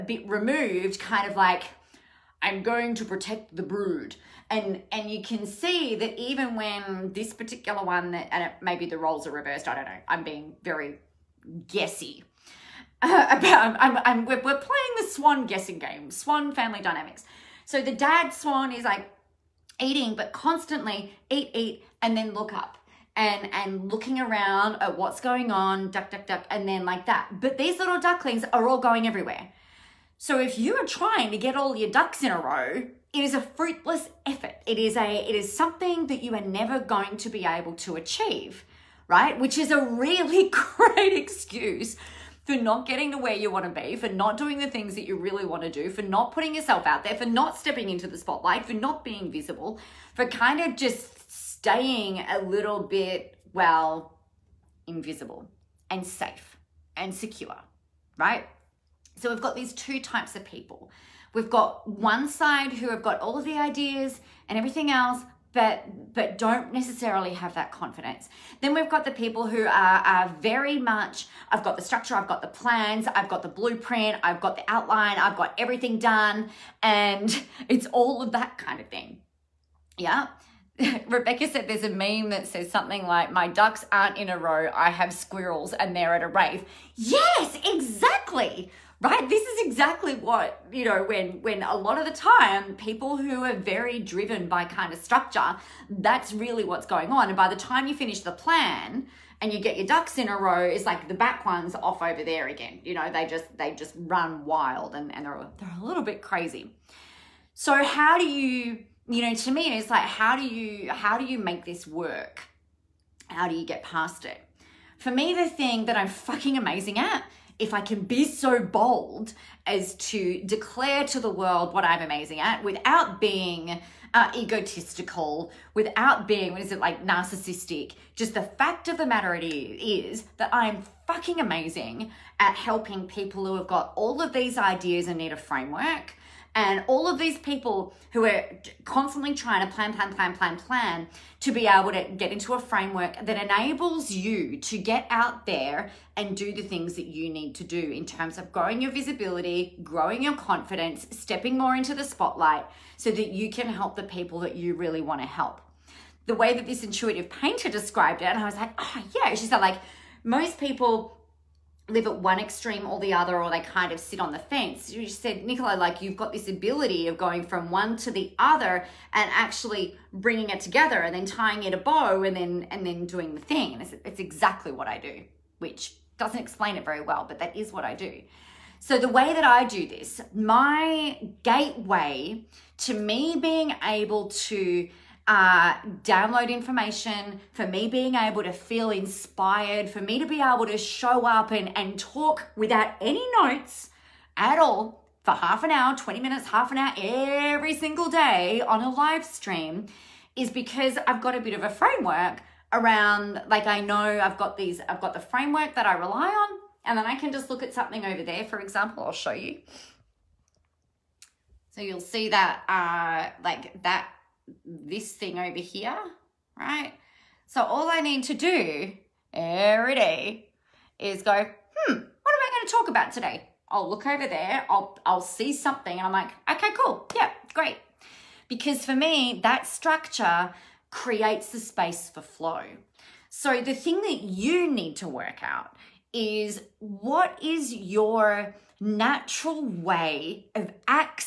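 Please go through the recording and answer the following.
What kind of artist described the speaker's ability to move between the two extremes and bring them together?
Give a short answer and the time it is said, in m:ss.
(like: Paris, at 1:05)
Intuitive painter, at 2:36.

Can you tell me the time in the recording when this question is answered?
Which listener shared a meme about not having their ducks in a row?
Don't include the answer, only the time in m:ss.
1:21.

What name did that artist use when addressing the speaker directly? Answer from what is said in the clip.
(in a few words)
Nicola.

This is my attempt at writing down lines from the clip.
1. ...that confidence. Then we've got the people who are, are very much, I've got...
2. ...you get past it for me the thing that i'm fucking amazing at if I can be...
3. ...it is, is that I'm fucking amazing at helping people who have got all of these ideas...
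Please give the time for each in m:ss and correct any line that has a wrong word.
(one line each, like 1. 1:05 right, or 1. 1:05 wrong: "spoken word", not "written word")
1. 1:07 right
2. 1:53 right
3. 2:09 right.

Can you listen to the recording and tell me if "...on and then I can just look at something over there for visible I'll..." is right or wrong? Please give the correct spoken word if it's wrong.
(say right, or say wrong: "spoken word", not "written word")
wrong: "example", not "visible".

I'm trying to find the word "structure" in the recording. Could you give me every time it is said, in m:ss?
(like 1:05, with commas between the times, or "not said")
1:11, 1:35, 3:49.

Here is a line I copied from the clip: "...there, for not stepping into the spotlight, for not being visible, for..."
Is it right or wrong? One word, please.
right.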